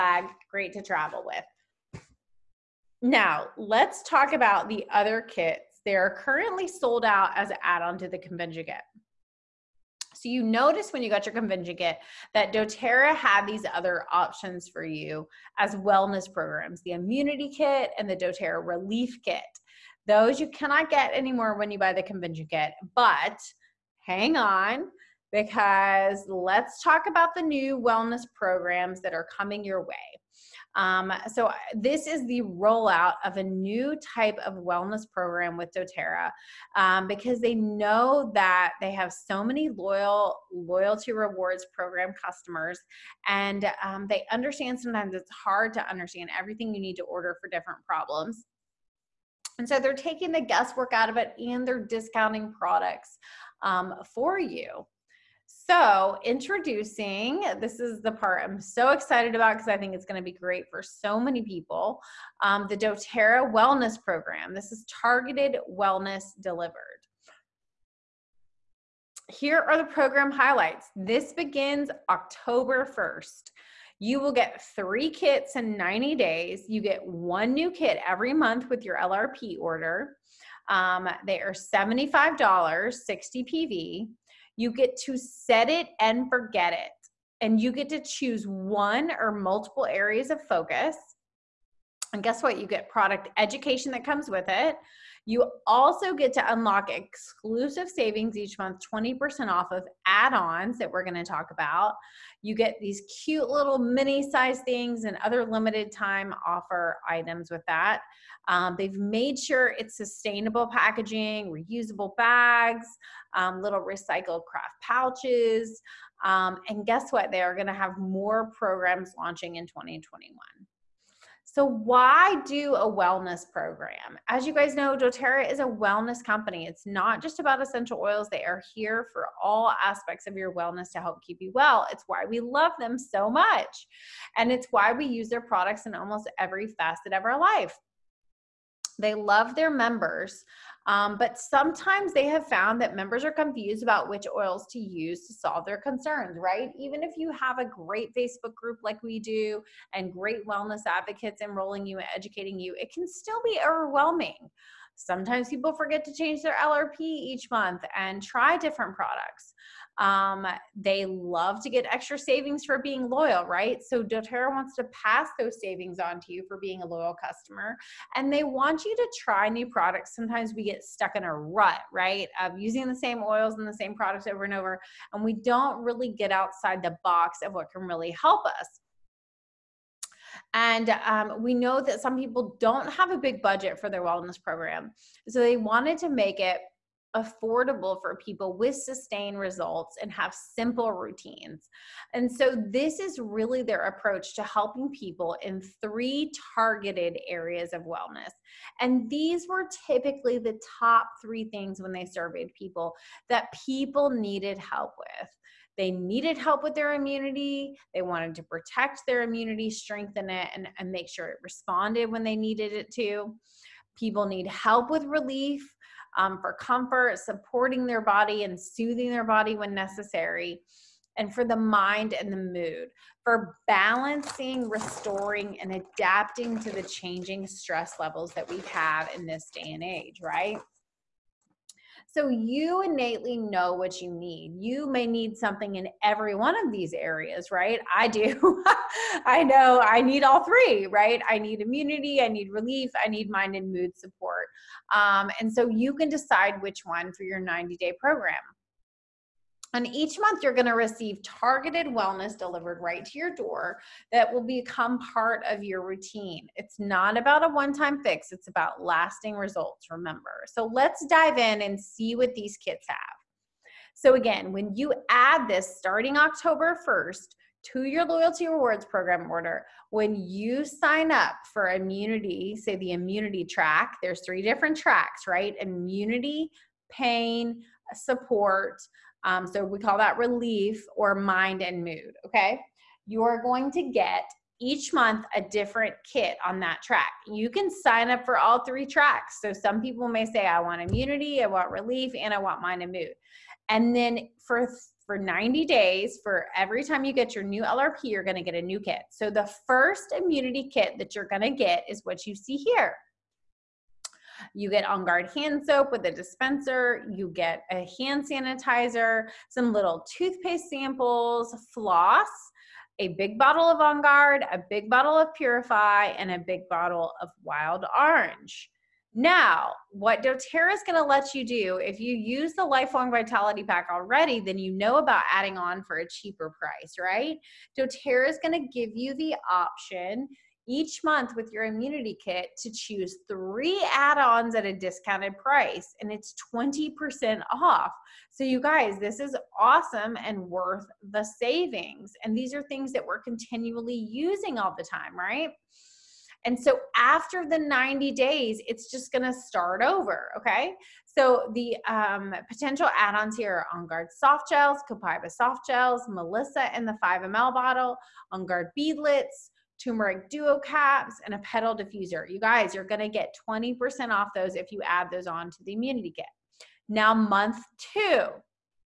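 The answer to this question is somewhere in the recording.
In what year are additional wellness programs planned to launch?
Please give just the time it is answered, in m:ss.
1:59.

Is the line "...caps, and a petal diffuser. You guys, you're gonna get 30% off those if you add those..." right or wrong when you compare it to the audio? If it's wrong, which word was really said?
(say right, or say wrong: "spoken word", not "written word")
wrong: "20", not "30".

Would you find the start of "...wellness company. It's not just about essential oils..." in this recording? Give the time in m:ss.
2:05.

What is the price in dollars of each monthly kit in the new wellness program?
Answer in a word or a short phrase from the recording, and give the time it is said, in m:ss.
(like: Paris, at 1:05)
$75, at 1:21.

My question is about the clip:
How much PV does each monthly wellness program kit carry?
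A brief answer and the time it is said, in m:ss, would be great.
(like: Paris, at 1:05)
60 PV, at 1:22.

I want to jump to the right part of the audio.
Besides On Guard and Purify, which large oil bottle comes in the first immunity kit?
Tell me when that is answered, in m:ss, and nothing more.
5:17.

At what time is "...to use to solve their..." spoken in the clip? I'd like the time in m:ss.
2:24.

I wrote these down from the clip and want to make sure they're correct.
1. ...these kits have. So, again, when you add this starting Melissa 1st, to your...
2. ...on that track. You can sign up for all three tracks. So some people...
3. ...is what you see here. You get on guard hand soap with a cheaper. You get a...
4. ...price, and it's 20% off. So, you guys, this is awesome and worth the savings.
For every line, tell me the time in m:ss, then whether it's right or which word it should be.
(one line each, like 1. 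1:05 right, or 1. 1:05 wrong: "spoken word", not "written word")
1. 4:22 wrong: "October", not "Melissa"
2. 4:46 right
3. 5:01 wrong: "dispenser", not "cheaper"
4. 5:35 right.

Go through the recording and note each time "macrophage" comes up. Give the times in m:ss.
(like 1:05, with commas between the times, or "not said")
not said.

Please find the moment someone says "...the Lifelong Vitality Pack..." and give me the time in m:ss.
5:22.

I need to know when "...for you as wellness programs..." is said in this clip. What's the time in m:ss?
0:14.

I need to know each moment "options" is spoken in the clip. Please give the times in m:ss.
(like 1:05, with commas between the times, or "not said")
0:14, 5:29.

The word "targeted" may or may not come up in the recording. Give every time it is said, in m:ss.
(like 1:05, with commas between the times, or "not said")
1:04, 3:16, 4:11.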